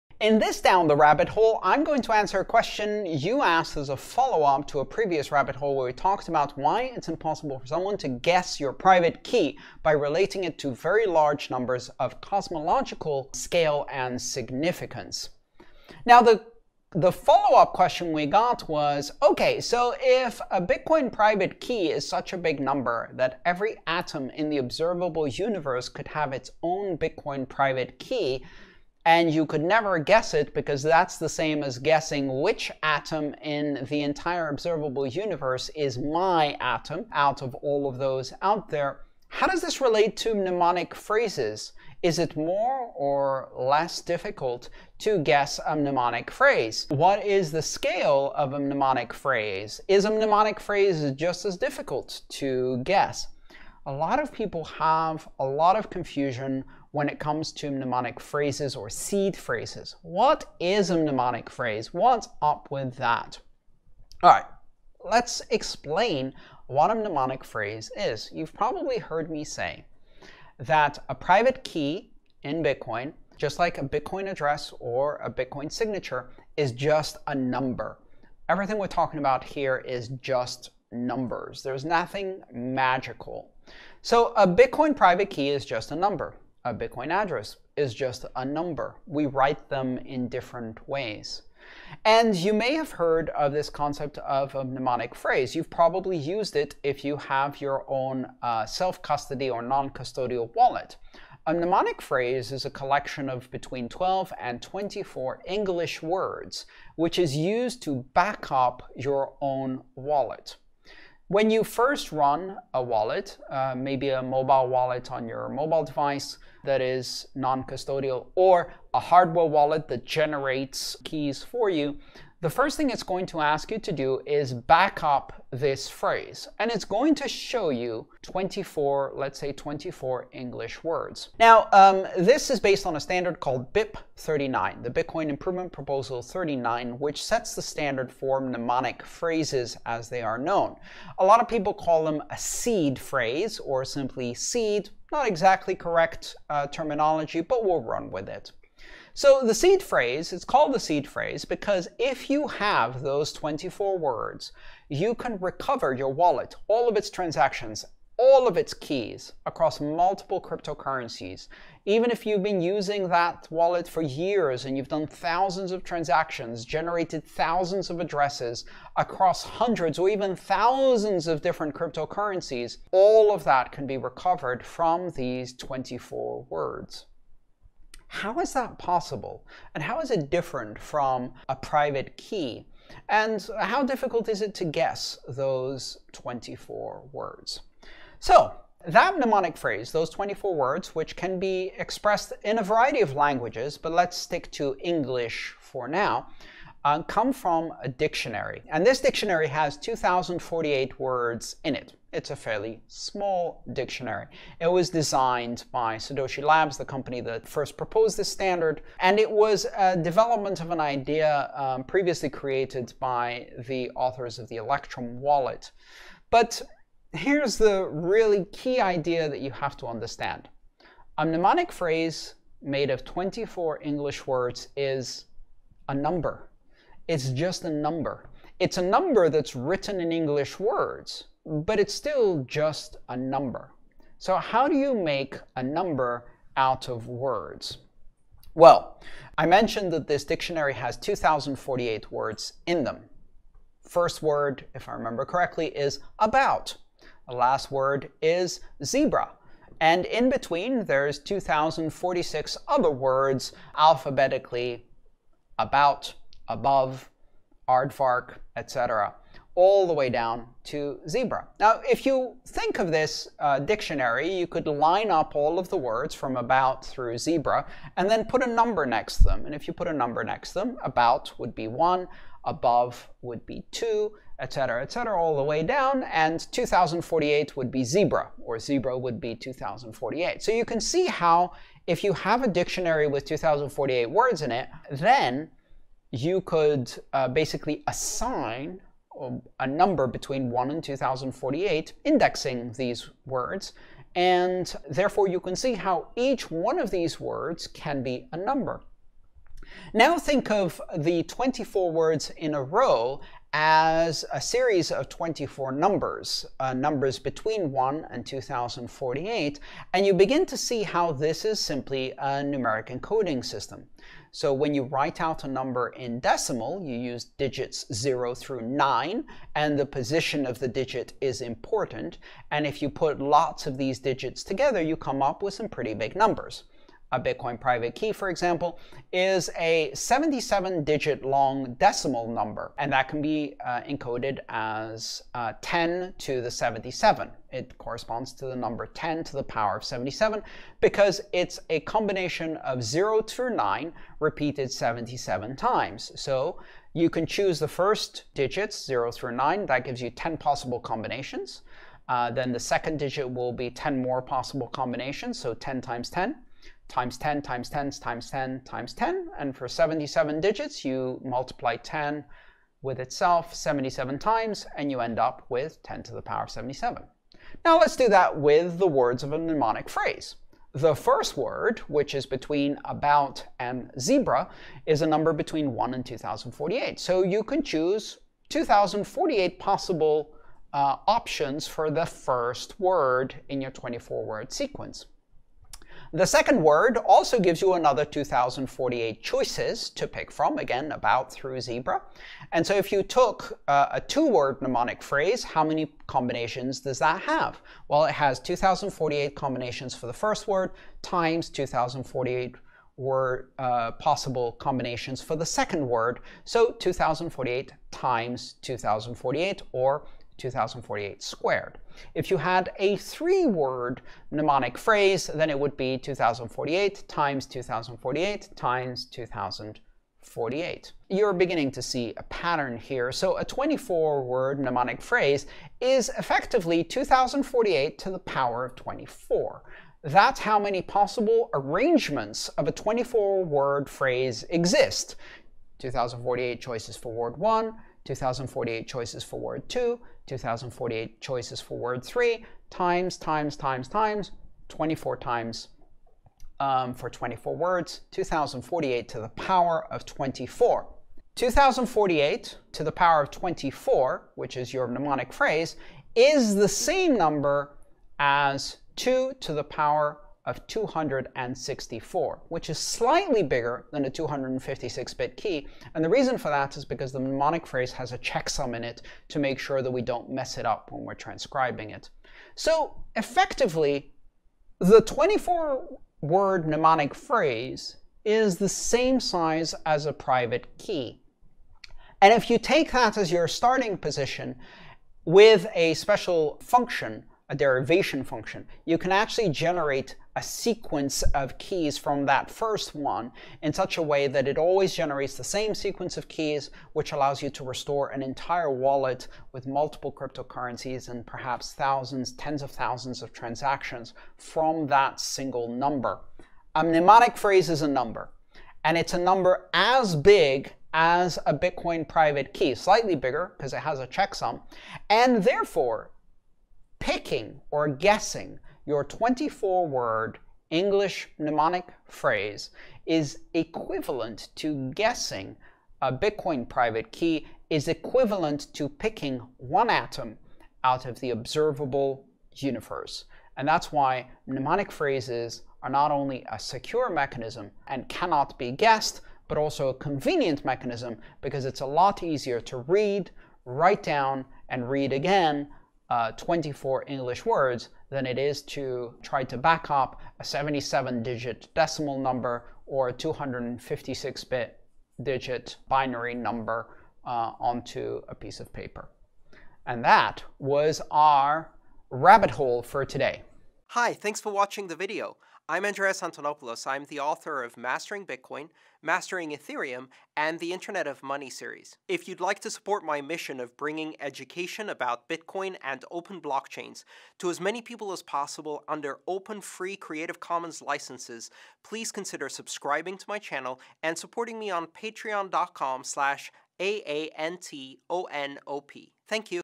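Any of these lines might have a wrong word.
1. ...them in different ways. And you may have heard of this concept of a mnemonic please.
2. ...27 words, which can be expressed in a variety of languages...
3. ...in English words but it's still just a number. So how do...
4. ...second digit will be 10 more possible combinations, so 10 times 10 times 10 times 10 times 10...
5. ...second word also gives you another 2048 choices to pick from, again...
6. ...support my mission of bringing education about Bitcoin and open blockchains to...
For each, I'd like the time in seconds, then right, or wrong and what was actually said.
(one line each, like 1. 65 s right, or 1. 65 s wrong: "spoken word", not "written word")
1. 89 s wrong: "phrase", not "please"
2. 190 s wrong: "24", not "27"
3. 230 s right
4. 352 s right
5. 386 s right
6. 572 s right.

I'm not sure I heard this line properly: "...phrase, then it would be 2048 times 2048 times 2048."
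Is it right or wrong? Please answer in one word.
right.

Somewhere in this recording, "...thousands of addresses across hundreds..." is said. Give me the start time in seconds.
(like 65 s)
167 s.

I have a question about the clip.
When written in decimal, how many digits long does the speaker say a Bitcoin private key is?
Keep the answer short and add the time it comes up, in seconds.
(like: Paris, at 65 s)
77, at 329 s.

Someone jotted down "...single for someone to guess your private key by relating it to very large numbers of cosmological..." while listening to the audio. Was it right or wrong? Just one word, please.
wrong.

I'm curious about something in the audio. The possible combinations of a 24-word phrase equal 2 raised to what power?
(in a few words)
264.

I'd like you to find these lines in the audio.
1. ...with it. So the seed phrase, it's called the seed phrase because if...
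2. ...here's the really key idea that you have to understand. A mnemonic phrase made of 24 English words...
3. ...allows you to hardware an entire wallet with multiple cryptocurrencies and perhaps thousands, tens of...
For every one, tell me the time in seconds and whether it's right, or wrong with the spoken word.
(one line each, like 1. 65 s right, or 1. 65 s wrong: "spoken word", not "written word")
1. 148 s right
2. 217 s right
3. 497 s wrong: "restore", not "hardware".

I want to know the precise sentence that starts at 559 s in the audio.
And that was our rabbit hole for today.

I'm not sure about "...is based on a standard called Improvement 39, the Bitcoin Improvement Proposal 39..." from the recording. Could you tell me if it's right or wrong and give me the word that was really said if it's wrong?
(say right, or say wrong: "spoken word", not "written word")
wrong: "BIP", not "Improvement".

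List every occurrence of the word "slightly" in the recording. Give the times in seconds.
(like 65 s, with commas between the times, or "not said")
462 s, 512 s.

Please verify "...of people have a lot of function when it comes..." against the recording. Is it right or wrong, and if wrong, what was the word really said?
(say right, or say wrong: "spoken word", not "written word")
wrong: "confusion", not "function".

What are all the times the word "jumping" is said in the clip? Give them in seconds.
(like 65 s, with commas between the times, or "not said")
not said.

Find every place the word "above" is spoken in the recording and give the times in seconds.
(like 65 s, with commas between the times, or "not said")
256 s, 272 s.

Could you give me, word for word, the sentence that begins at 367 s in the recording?
Now let's do that with the words of a mnemonic phrase.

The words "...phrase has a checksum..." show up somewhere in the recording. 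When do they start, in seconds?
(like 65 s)
467 s.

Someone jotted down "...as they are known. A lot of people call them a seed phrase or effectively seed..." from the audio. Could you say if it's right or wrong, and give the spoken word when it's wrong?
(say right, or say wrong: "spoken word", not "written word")
wrong: "simply", not "effectively".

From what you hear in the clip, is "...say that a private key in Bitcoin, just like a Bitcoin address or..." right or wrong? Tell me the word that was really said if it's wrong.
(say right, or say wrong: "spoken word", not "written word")
right.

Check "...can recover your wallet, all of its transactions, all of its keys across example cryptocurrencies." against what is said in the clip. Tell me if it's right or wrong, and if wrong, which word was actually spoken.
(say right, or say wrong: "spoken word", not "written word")
wrong: "multiple", not "example".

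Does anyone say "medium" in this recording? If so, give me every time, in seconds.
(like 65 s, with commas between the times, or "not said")
not said.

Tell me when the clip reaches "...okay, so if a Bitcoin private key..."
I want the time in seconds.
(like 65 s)
19 s.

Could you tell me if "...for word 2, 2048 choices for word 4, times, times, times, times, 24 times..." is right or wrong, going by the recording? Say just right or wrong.
wrong.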